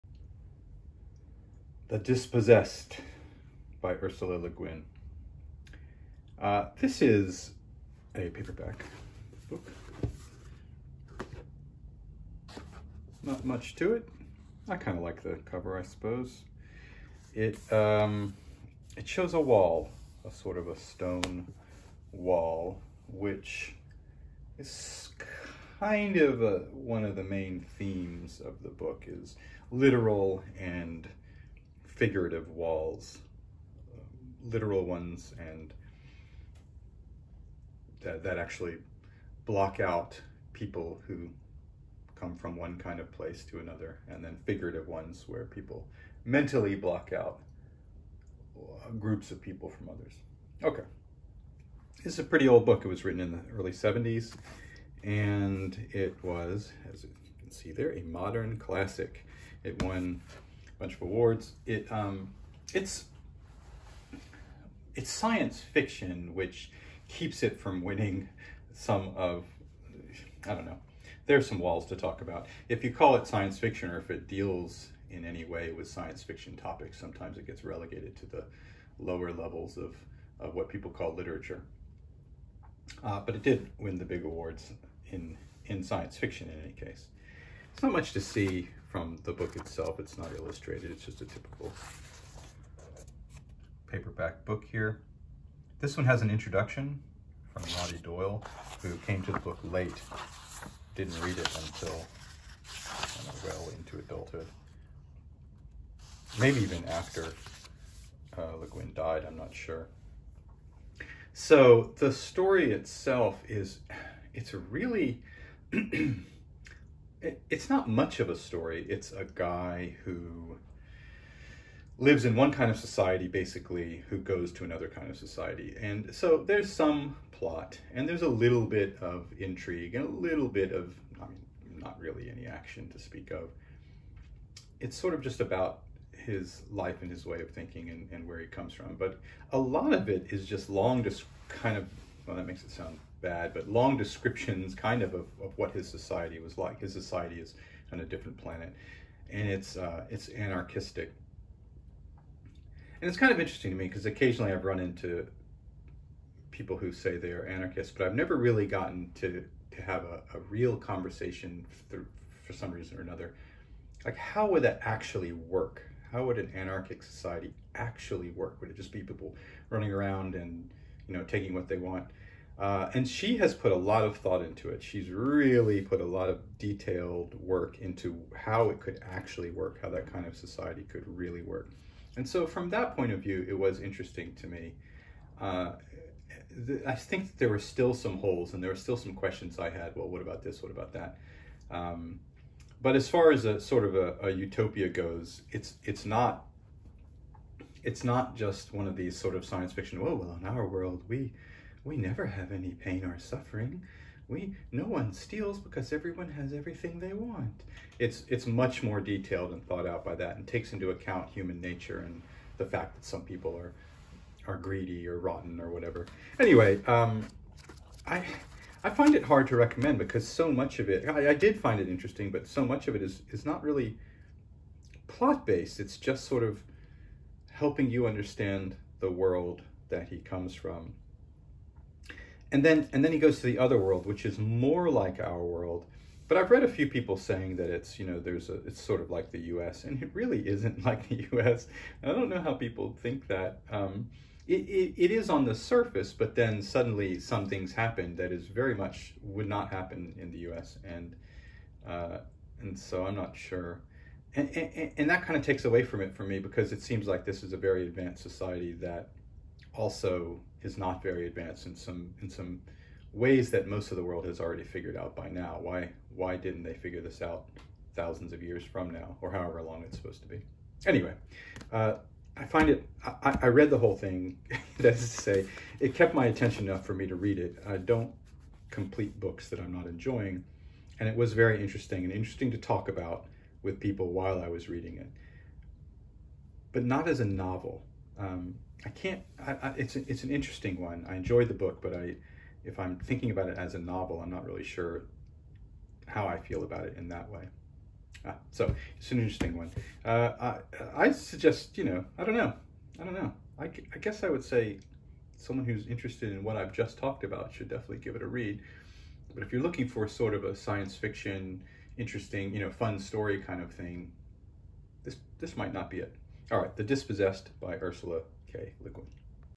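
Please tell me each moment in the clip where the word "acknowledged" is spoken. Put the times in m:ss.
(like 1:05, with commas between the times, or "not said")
not said.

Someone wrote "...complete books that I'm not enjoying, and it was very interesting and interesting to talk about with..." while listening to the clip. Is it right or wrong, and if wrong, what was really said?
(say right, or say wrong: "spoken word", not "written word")
right.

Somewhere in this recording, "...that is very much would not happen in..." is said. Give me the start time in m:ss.
4:08.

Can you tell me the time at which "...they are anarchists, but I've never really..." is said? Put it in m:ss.
2:37.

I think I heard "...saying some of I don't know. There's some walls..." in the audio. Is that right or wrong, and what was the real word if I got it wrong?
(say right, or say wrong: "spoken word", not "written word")
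wrong: "winning", not "saying".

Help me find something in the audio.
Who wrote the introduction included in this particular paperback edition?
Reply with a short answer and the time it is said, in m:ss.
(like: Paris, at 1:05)
Roddy Doyle, at 1:37.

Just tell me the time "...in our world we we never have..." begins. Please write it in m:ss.
3:20.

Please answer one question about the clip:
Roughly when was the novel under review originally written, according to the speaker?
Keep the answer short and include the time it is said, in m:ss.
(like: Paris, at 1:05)
Early 70s, at 0:53.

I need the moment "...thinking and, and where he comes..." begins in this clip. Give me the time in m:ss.
2:17.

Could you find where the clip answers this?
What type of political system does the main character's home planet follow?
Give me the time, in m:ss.
2:30.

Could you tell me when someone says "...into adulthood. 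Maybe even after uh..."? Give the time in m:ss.
1:43.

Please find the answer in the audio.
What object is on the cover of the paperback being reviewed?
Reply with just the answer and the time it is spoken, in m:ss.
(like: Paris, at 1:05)
A stone wall, at 0:20.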